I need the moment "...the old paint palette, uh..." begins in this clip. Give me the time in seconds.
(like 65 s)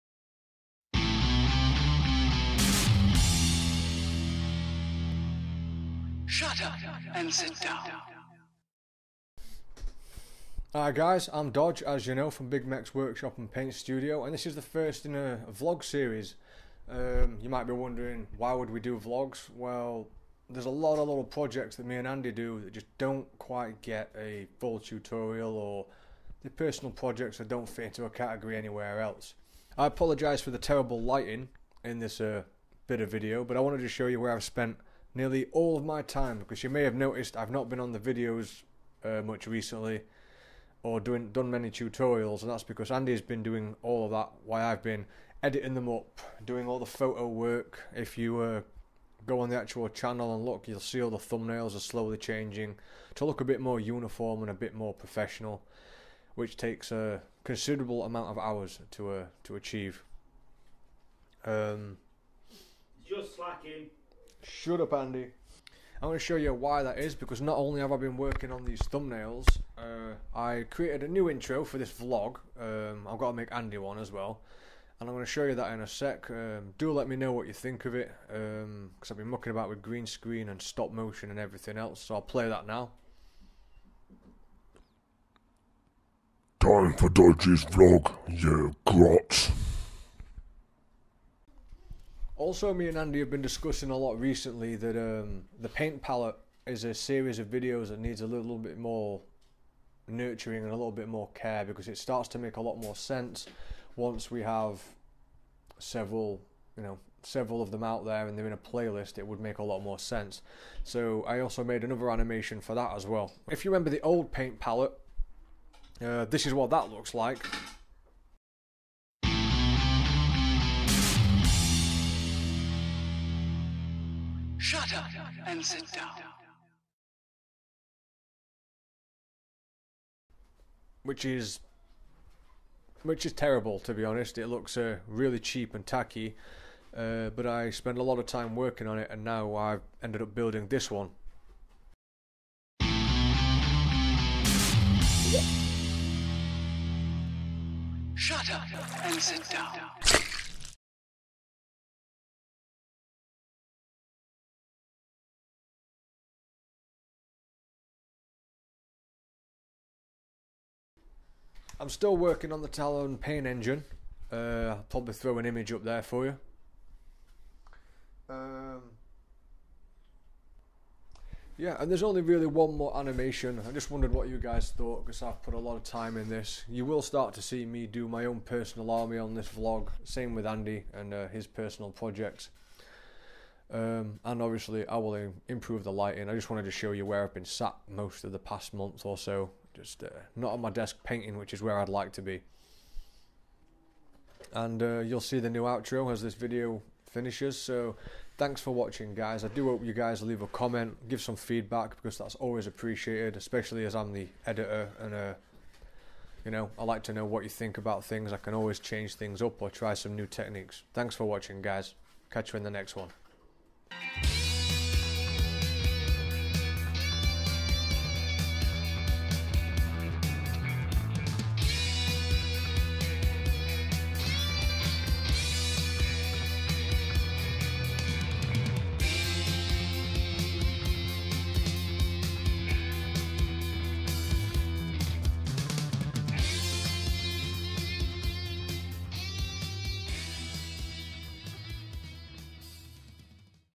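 113 s.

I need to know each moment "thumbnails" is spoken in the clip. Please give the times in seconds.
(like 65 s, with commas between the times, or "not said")
51 s, 68 s.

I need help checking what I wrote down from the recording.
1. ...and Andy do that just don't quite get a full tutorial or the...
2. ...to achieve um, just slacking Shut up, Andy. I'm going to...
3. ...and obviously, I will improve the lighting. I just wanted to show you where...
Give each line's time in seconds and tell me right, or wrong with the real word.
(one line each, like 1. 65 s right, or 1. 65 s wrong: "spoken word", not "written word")
1. 21 s right
2. 59 s right
3. 184 s right.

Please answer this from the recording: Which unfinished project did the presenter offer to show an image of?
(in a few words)
Talos pain engine.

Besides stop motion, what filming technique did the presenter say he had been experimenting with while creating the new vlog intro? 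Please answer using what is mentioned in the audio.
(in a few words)
Green screen.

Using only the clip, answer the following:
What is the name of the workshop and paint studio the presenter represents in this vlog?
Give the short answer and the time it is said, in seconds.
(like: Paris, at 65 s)
Big Meks Workshop, at 12 s.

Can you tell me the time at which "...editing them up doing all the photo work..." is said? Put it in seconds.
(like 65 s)
45 s.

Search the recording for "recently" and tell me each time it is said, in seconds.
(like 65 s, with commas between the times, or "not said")
39 s, 94 s.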